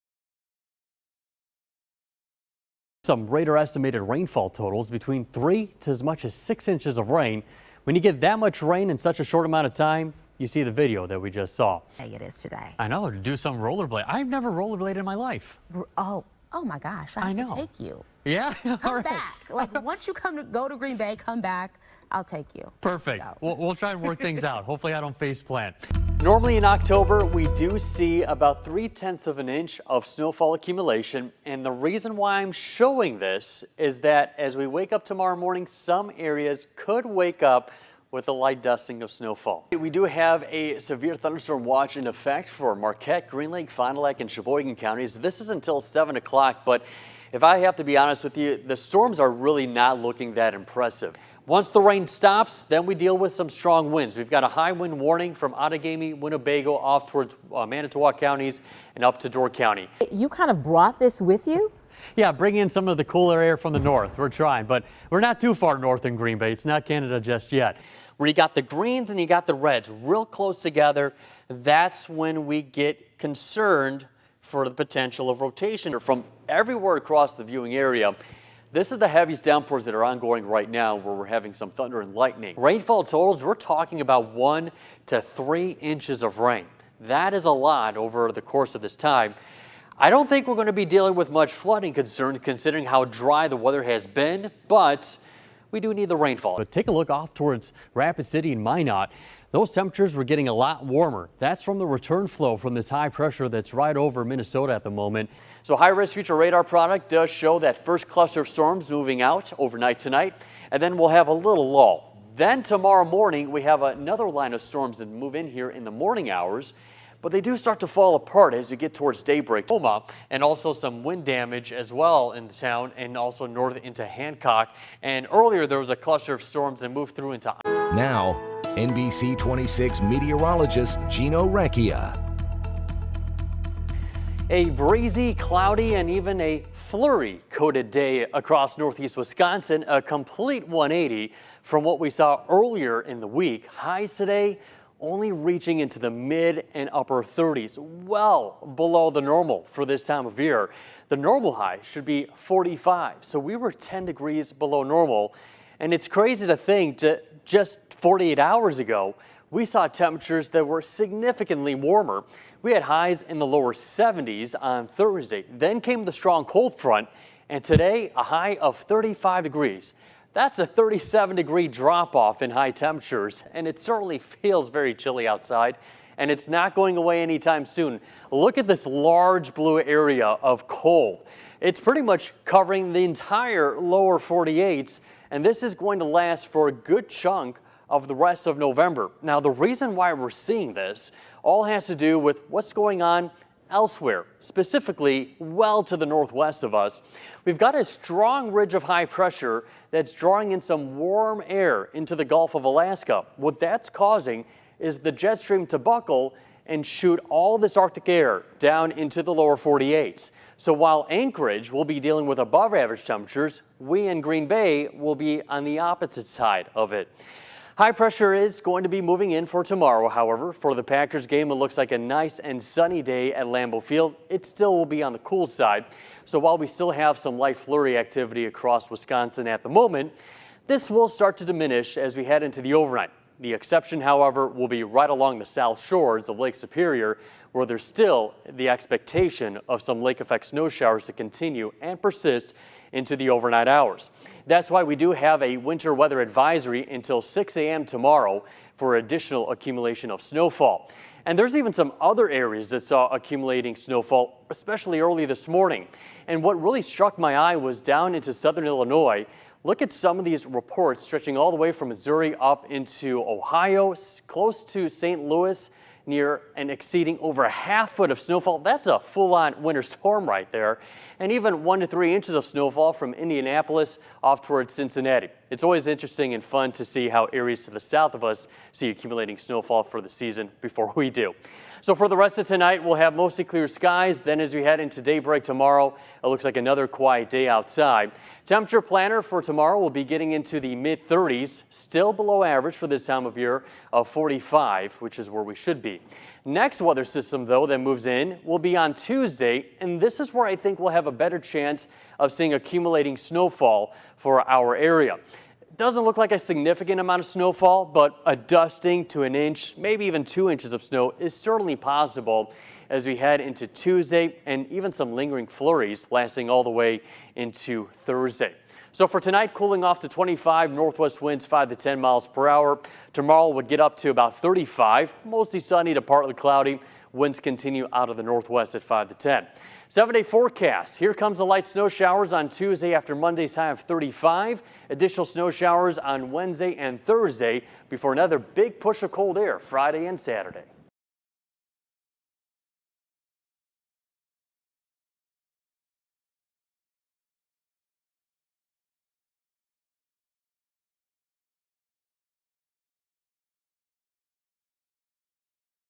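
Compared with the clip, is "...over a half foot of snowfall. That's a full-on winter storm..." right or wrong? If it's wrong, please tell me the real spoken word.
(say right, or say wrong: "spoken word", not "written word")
right.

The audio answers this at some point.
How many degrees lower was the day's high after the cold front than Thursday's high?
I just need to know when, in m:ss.
2:50.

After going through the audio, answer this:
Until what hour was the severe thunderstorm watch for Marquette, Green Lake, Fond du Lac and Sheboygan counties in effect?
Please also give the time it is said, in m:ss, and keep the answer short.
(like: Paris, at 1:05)
7 o'clock, at 0:45.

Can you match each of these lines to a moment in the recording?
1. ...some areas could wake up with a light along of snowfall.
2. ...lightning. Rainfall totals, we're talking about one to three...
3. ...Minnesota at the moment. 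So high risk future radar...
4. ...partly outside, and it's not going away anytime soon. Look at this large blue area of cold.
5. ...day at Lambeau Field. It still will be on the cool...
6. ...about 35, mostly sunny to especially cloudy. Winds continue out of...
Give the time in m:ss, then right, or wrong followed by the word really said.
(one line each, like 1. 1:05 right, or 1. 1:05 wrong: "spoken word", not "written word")
1. 0:35 wrong: "dusting", not "along"
2. 1:22 right
3. 1:44 right
4. 2:54 wrong: "chilly", not "partly"
5. 3:43 right
6. 5:24 wrong: "partly", not "especially".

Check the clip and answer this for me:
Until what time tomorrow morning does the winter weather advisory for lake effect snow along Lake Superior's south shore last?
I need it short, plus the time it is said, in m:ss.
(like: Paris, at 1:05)
6 a.m., at 4:07.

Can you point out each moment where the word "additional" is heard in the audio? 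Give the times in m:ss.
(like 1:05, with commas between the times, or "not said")
4:08, 5:34.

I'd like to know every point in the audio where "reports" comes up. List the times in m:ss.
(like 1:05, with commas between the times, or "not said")
4:20.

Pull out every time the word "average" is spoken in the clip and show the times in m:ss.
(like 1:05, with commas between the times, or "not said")
3:32, 4:52.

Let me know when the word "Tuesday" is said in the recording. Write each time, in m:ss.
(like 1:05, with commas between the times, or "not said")
4:58, 5:13, 5:32.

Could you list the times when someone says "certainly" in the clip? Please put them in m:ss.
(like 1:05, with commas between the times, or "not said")
2:53, 5:11.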